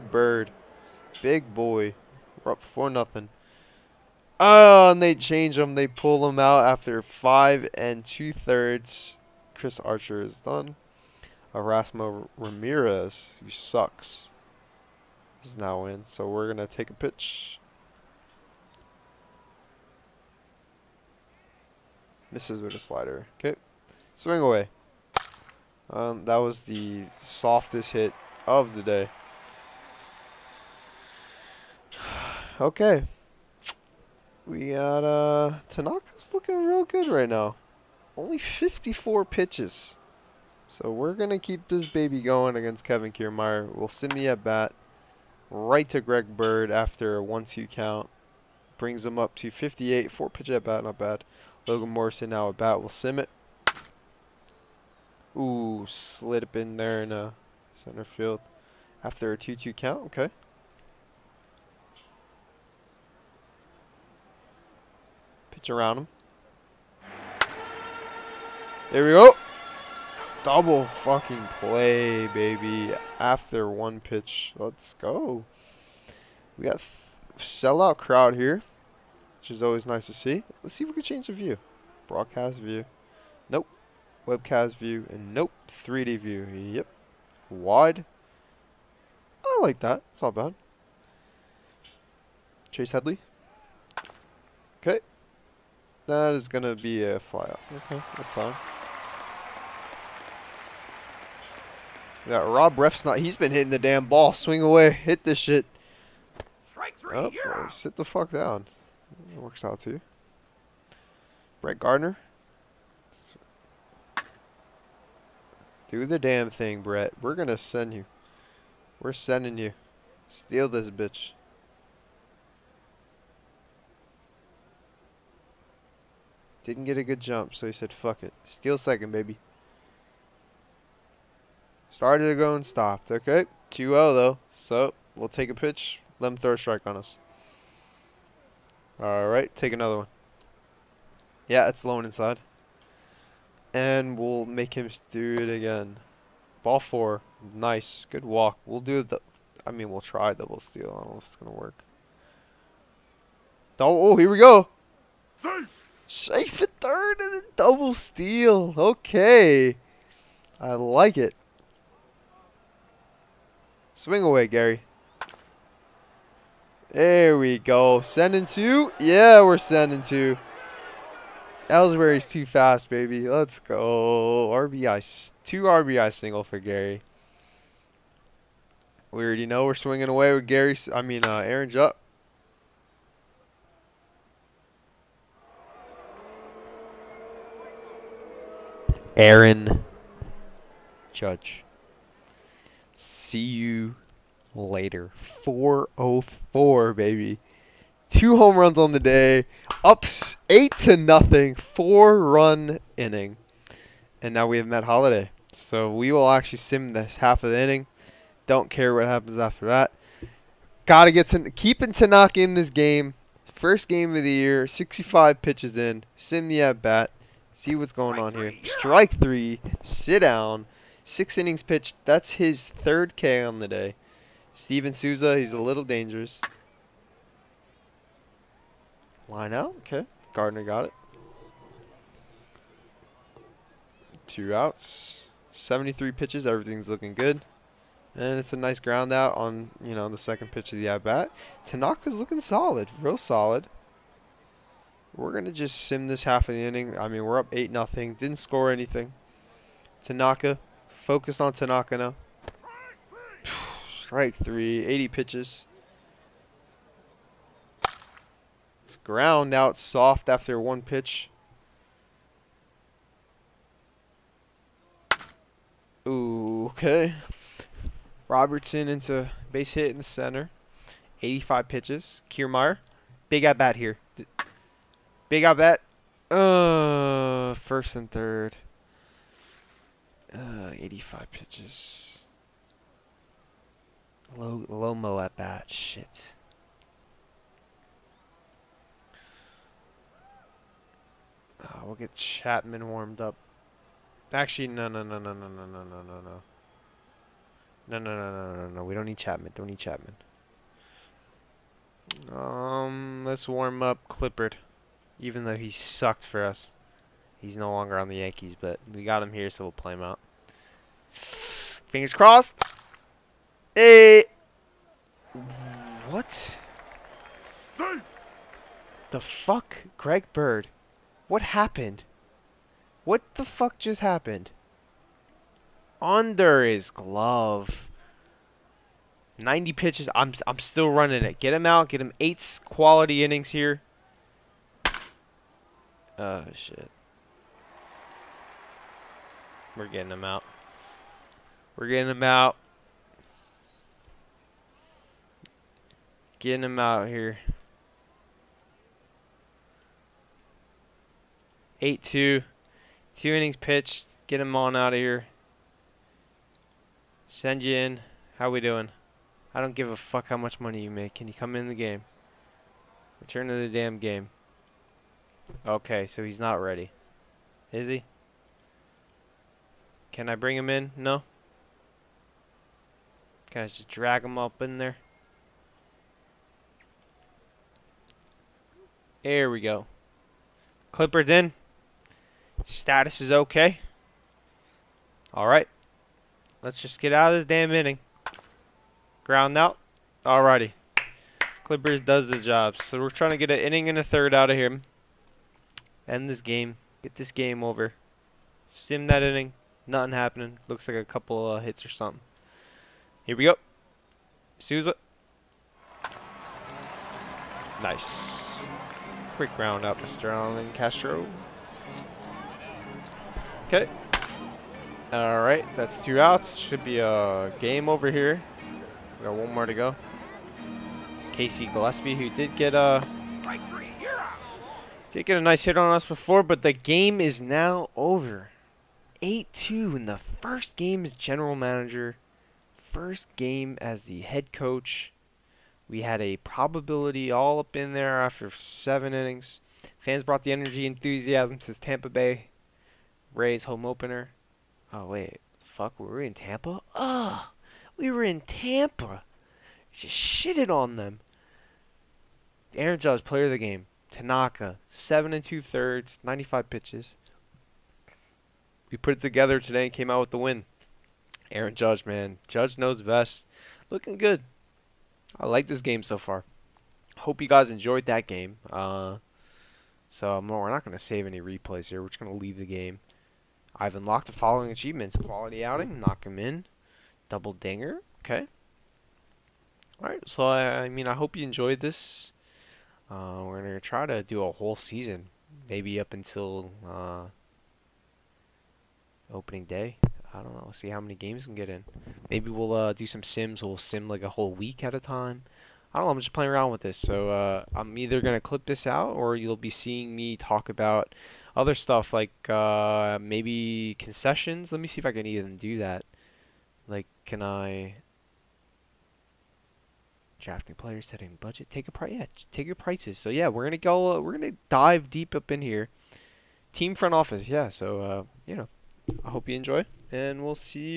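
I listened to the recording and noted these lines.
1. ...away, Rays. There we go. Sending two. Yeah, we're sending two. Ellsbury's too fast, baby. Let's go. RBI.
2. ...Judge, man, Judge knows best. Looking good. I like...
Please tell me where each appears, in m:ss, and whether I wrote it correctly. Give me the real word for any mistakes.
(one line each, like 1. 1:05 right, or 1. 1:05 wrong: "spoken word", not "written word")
1. 2:44 wrong: "Gary", not "Rays"
2. 7:41 right.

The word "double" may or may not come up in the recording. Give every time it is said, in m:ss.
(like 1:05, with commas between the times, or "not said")
1:10, 2:30, 2:37, 7:57.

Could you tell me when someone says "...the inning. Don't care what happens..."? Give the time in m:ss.
3:27.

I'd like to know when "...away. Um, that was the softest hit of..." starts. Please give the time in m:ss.
0:24.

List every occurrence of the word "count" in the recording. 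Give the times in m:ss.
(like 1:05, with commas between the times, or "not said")
0:47, 0:59.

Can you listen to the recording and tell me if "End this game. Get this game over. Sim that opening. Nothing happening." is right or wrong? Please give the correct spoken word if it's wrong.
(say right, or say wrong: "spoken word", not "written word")
wrong: "inning", not "opening".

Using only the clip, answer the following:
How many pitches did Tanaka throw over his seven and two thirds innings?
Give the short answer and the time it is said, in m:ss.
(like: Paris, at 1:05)
95, at 7:36.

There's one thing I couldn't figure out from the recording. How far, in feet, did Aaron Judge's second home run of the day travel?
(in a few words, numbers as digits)
404.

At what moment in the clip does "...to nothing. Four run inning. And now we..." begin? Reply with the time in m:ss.
3:20.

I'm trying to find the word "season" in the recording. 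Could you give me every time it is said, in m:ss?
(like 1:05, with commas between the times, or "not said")
8:04.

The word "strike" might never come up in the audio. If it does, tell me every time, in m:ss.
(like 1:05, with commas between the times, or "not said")
1:46, 2:16, 3:38, 4:14.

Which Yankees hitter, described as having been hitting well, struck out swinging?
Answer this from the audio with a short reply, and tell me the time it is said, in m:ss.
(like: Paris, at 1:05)
Rob Refsnyder, at 1:42.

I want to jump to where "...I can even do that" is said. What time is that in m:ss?
8:25.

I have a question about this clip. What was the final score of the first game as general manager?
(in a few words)
8-2.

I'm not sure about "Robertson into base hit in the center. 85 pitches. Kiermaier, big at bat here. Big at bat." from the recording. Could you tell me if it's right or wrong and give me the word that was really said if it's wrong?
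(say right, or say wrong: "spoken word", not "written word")
right.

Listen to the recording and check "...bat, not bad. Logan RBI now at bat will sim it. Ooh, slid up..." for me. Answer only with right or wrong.
wrong.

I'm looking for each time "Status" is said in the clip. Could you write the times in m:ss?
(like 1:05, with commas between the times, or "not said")
6:22.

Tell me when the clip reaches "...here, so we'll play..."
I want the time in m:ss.
5:09.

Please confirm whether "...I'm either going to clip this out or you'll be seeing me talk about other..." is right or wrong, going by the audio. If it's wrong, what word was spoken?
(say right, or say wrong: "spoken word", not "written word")
right.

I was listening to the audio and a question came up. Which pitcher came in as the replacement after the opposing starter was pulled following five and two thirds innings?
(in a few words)
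Erasmo Ramirez.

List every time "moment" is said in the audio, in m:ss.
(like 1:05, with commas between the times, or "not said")
not said.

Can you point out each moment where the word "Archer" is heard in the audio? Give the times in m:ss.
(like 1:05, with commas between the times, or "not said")
0:09.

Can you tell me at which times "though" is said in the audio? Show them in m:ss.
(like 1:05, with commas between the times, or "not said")
2:14, 5:05.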